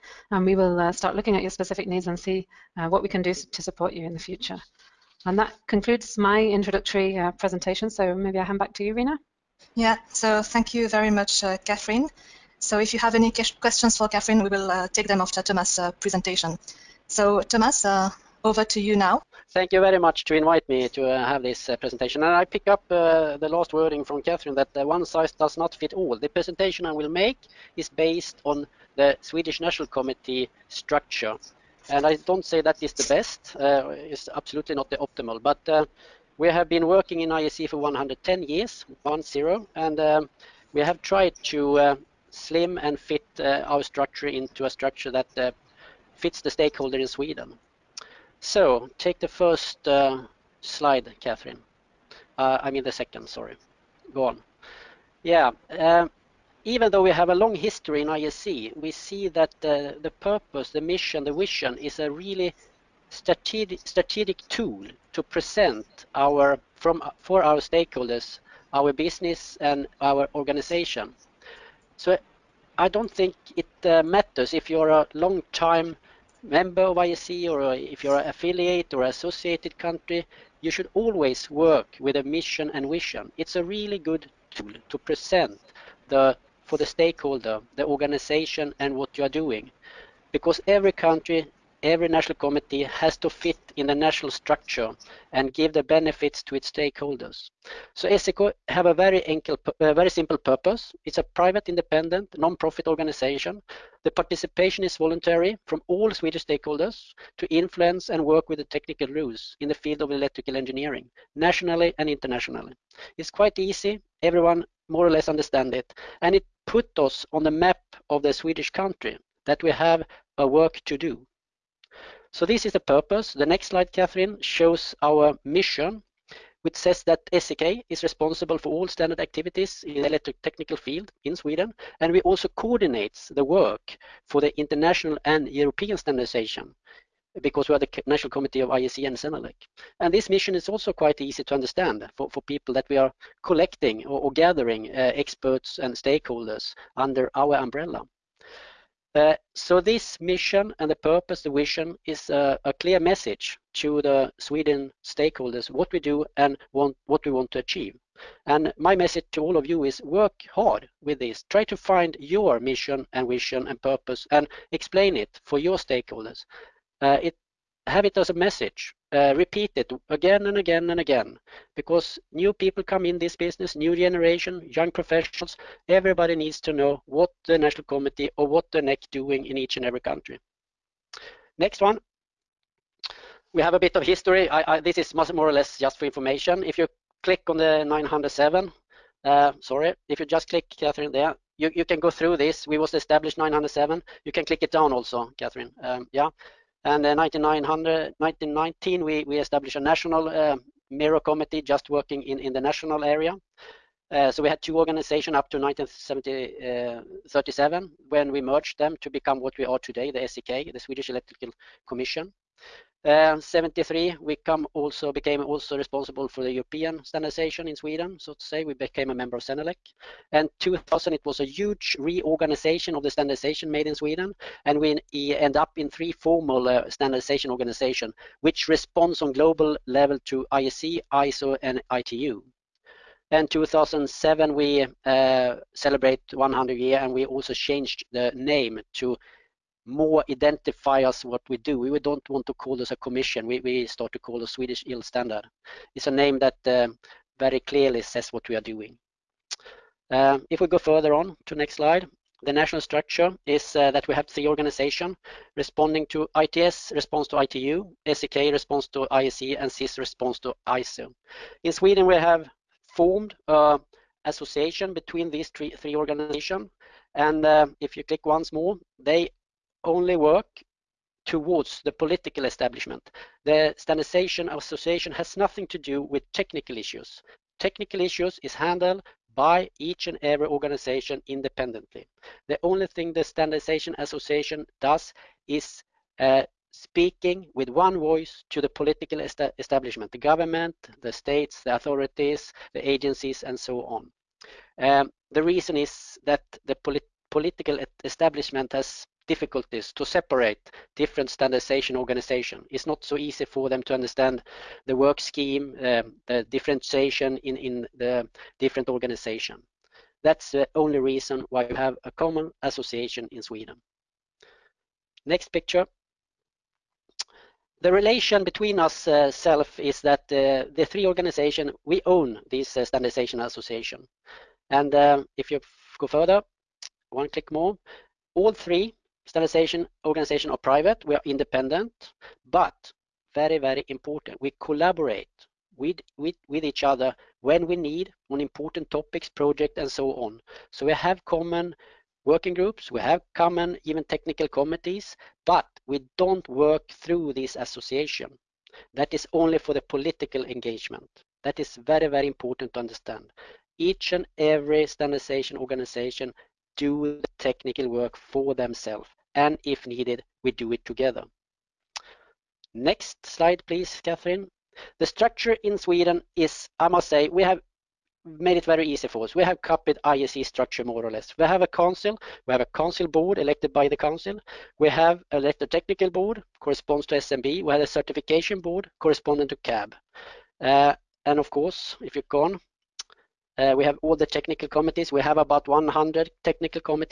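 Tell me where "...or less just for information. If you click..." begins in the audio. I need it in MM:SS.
03:05.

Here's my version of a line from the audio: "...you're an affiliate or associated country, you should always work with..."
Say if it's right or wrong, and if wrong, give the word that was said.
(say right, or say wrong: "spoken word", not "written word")
right.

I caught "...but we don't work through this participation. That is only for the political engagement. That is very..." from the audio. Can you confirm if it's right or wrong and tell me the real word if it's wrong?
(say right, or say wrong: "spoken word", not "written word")
wrong: "association", not "participation".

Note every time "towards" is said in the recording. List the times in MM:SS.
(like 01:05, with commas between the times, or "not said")
04:31.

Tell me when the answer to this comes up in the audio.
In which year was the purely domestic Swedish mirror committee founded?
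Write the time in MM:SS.
03:17.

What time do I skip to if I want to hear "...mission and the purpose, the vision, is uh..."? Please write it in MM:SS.
02:30.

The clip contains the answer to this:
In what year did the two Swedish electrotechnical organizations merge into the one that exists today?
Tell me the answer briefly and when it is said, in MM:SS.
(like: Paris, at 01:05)
1937, at 03:25.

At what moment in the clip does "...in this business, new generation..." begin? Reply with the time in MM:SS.
02:53.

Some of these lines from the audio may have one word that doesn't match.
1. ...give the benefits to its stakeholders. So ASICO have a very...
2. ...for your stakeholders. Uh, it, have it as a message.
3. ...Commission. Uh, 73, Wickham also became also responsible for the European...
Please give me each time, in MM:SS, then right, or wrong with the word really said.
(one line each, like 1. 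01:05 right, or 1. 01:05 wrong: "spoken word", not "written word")
1. 01:35 right
2. 02:45 right
3. 03:31 right.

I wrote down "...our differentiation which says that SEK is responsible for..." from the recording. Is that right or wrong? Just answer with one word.
wrong.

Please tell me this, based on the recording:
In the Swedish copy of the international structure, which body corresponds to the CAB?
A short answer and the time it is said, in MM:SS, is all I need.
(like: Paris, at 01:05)
certification board, at 06:17.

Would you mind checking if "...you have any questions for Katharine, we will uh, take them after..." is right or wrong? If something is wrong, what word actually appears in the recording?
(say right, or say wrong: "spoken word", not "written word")
right.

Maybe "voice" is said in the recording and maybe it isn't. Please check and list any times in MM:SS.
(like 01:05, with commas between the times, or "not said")
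04:47.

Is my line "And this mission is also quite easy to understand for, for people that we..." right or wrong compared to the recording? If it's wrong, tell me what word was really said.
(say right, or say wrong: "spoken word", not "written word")
right.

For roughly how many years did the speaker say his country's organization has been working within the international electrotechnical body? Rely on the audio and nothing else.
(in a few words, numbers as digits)
110.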